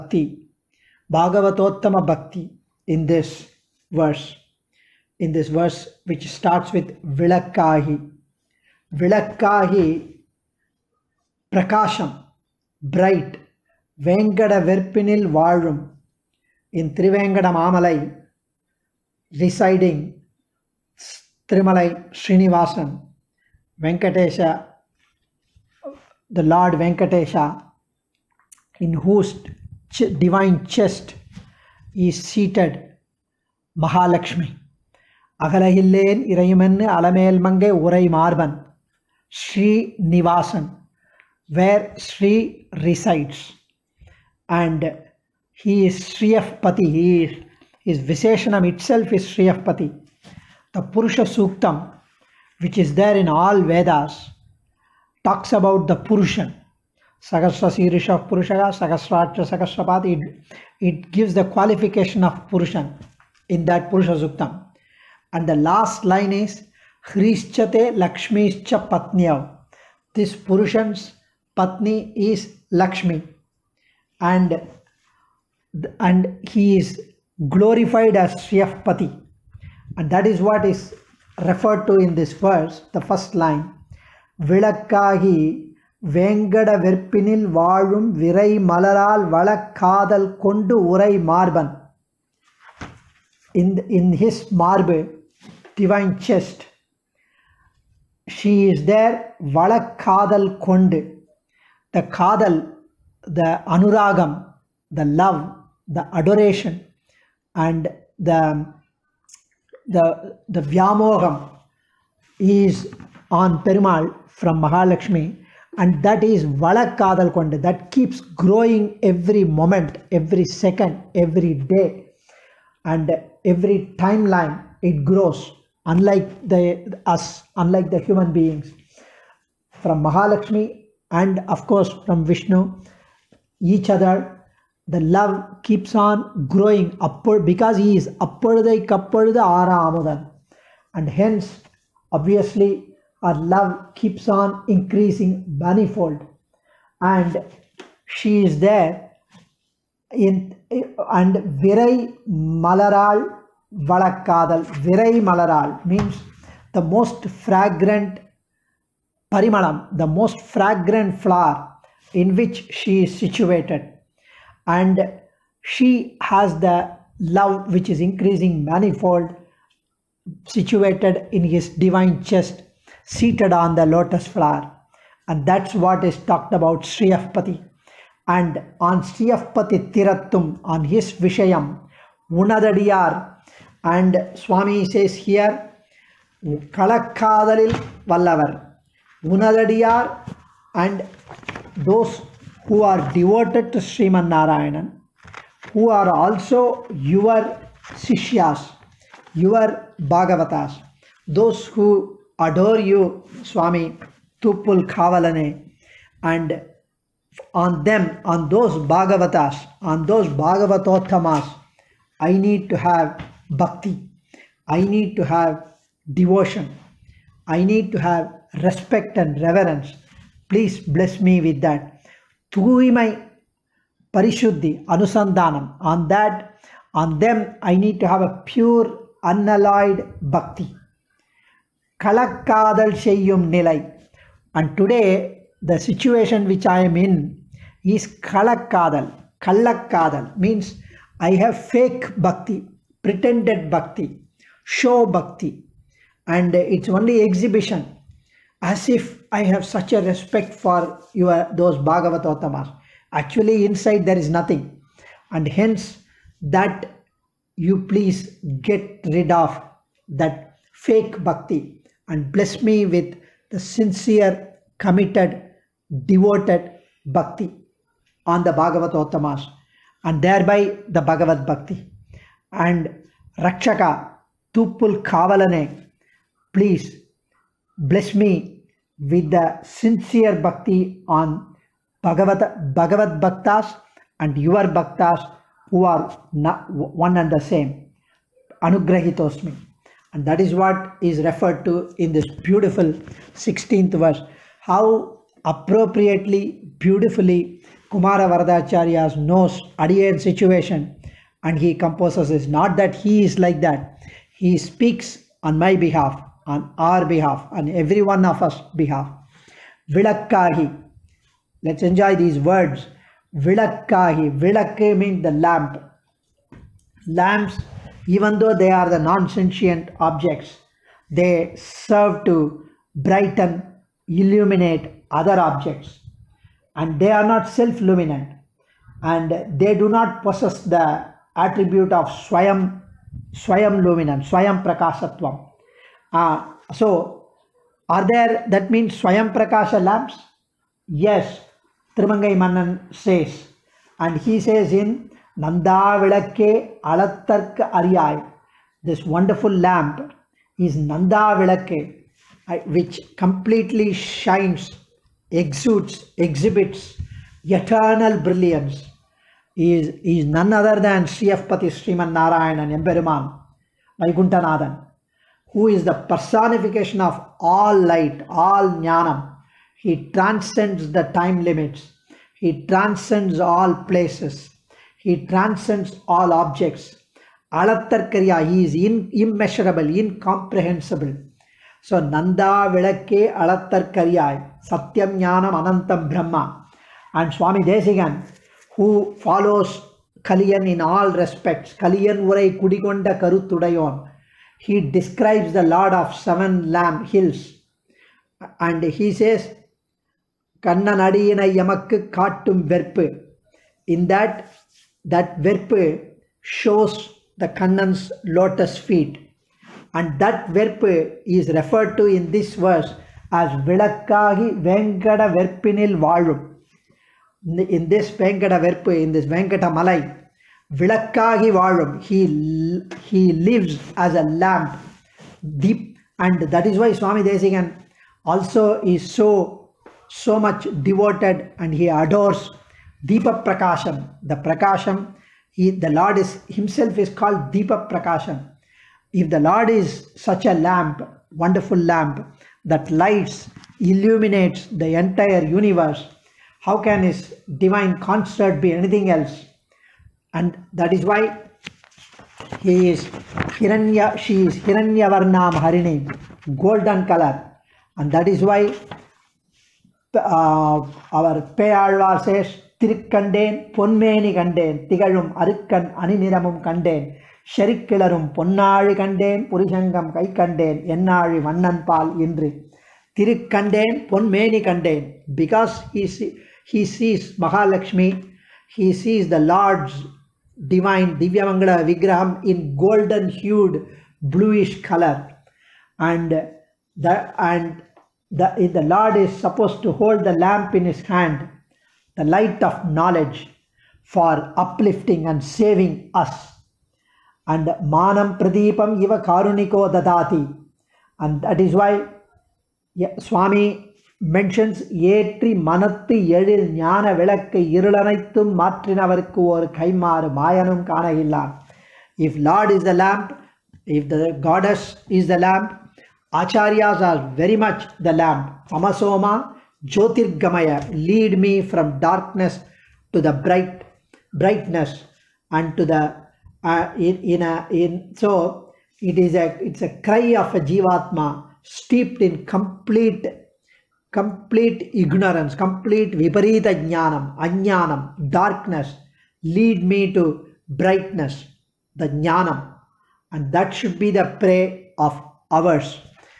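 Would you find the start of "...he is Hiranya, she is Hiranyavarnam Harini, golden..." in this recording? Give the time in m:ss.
7:32.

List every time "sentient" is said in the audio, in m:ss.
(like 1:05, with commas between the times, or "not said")
5:18.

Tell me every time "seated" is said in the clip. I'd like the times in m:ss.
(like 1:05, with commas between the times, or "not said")
0:32, 2:53.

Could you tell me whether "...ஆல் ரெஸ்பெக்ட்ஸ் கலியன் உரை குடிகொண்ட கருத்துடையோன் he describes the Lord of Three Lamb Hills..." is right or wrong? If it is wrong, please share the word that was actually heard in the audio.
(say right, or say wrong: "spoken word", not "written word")
wrong: "Seven", not "Three".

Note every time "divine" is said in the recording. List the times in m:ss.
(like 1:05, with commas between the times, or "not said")
0:30, 2:51, 7:27, 8:00.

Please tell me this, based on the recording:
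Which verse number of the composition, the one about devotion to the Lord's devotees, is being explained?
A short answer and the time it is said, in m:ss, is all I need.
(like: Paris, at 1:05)
16th, at 4:53.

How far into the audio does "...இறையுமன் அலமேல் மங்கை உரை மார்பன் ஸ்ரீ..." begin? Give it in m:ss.
0:36.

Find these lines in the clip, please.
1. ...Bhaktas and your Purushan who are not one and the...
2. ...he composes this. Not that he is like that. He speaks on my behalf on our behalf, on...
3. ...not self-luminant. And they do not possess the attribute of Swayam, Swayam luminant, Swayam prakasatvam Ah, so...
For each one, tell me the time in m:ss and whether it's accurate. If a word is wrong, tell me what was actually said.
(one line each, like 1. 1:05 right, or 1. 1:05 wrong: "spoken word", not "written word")
1. 4:43 wrong: "Bhaktas", not "Purushan"
2. 5:01 right
3. 5:27 right.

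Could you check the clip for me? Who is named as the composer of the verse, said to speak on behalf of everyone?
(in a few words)
Kumara Varadacharya.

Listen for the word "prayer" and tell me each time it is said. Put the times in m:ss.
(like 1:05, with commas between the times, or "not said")
9:04.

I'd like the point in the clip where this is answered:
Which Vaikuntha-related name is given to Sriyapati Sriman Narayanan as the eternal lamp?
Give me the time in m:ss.
6:02.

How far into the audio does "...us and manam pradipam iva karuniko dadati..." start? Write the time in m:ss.
8:16.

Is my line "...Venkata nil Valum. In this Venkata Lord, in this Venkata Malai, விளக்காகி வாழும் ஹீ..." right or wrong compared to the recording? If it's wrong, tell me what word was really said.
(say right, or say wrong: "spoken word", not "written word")
wrong: "Verpu", not "Lord".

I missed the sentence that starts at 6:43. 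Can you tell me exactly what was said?
In that, that Verpu shows the Kannan's lotus feet.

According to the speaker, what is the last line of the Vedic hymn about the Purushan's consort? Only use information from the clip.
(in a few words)
Lakshmi Lakshmischa Patnyav.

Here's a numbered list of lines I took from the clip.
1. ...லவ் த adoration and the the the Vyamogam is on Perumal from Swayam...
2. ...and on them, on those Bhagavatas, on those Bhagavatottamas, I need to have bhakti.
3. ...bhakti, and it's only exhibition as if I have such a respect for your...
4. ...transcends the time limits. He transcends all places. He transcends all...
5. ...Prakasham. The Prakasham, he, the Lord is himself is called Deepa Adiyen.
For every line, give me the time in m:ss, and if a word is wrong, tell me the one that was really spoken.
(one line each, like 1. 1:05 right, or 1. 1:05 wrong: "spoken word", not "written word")
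1. 1:45 wrong: "Mahalakshmi", not "Swayam"
2. 3:26 right
3. 4:05 right
4. 6:10 right
5. 7:13 wrong: "Prakasham", not "Adiyen".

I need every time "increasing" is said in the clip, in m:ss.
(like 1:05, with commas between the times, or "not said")
2:24, 2:48.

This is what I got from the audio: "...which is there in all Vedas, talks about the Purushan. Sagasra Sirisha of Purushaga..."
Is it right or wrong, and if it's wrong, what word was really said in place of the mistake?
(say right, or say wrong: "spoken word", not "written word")
right.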